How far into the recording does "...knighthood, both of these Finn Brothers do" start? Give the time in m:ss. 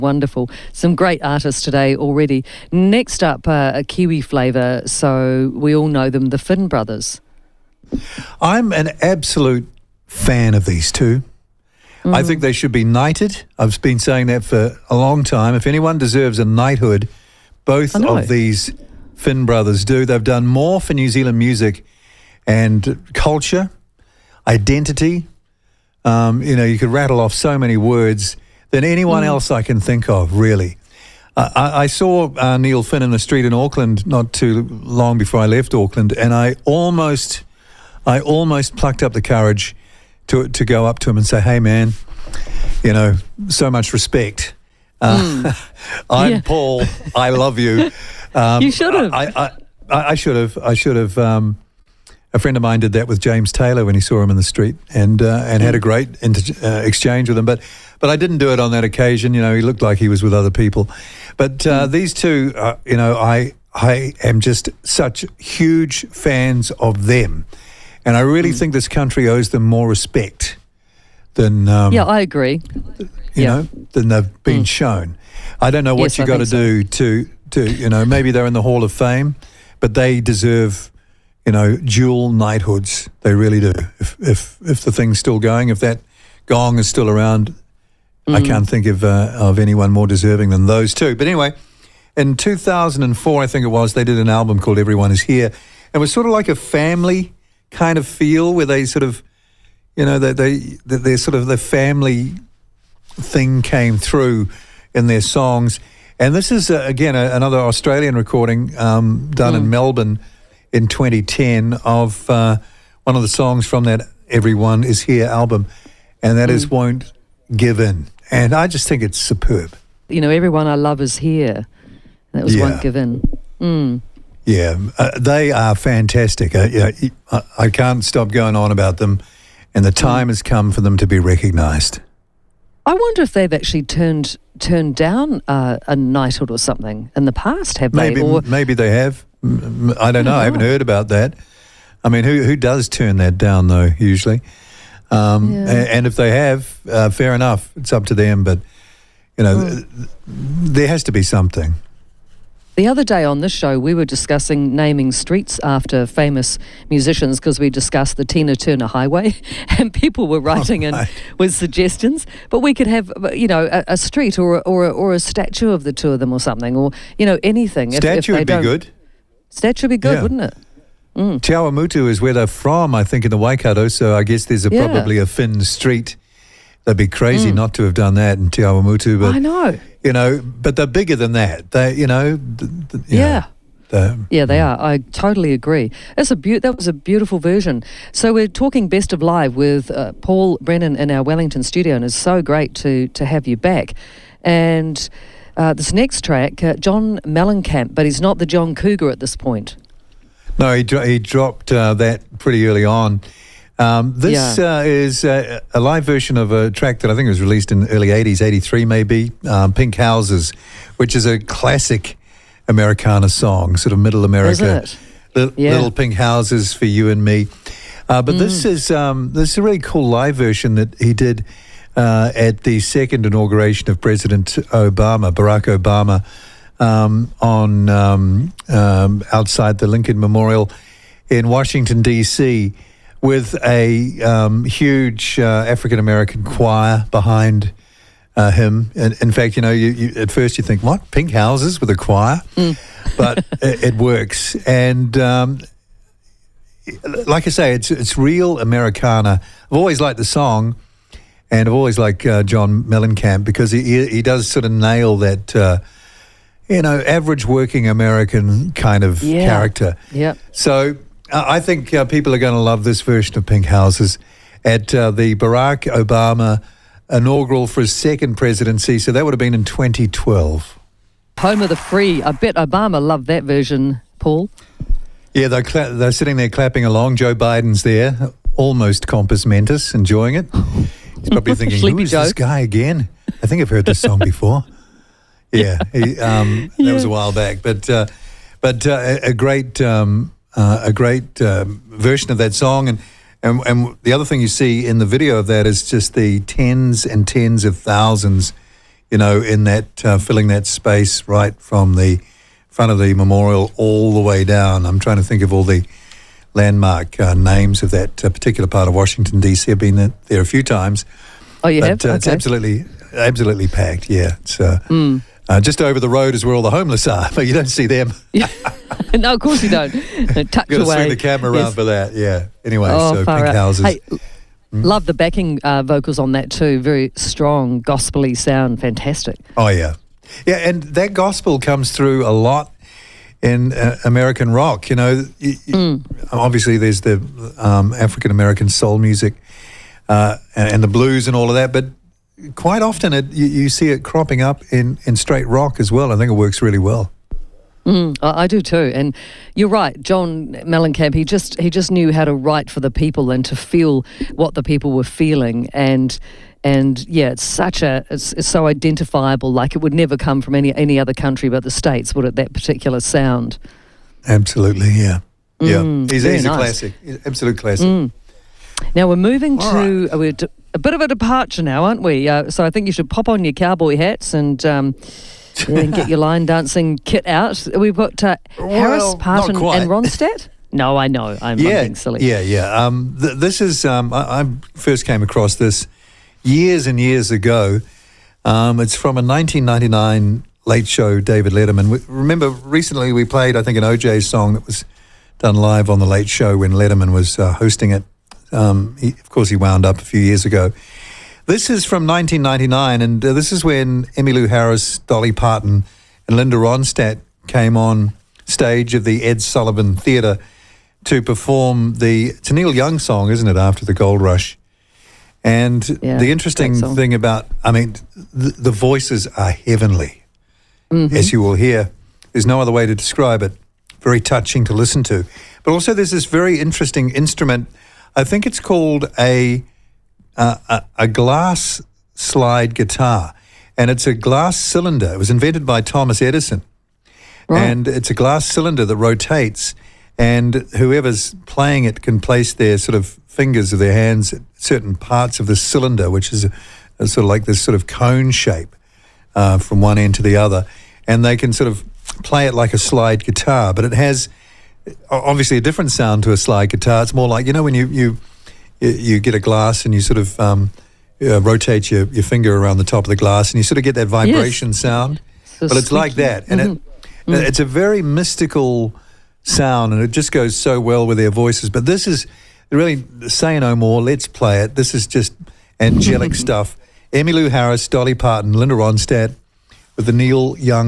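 0:16.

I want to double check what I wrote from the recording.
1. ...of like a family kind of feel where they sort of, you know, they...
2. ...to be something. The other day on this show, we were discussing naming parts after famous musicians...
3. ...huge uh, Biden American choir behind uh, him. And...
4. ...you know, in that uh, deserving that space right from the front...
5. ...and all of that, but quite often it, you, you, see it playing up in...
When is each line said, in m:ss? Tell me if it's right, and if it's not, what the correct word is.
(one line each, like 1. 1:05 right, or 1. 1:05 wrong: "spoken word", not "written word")
1. 1:36 right
2. 2:31 wrong: "streets", not "parts"
3. 3:54 wrong: "African", not "Biden"
4. 4:59 wrong: "filling", not "deserving"
5. 5:41 wrong: "cropping", not "playing".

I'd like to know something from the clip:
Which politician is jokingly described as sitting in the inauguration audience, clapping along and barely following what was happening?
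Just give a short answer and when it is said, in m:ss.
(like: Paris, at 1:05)
Joe Biden, at 4:37.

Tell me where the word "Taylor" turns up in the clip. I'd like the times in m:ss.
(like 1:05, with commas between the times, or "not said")
0:53.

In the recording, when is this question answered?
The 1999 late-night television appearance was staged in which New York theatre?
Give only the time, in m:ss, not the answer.
6:49.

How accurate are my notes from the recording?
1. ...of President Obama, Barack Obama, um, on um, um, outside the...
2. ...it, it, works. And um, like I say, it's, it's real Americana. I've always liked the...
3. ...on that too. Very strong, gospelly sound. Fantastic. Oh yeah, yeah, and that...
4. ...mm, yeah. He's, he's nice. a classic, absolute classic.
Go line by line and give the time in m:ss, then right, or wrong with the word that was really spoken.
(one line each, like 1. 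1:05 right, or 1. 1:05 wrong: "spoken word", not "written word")
1. 3:43 right
2. 4:03 right
3. 5:26 right
4. 6:05 right.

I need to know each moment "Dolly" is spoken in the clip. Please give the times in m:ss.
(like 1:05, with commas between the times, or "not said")
6:44, 7:57.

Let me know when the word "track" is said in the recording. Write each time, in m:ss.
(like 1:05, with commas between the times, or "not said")
3:16, 3:26.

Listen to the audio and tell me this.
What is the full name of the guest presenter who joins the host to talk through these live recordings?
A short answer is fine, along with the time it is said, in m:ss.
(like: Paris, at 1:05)
Paul Brennan, at 3:10.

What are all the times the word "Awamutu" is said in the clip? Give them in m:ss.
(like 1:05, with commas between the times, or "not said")
2:51, 2:58.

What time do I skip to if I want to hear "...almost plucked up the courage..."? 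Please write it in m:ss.
0:38.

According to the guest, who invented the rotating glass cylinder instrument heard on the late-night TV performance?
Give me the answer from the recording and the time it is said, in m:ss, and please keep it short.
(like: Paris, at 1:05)
Thomas Edison, at 7:15.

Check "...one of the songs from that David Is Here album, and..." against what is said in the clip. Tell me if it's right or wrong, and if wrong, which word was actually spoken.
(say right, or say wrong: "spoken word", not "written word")
wrong: "Everyone", not "David".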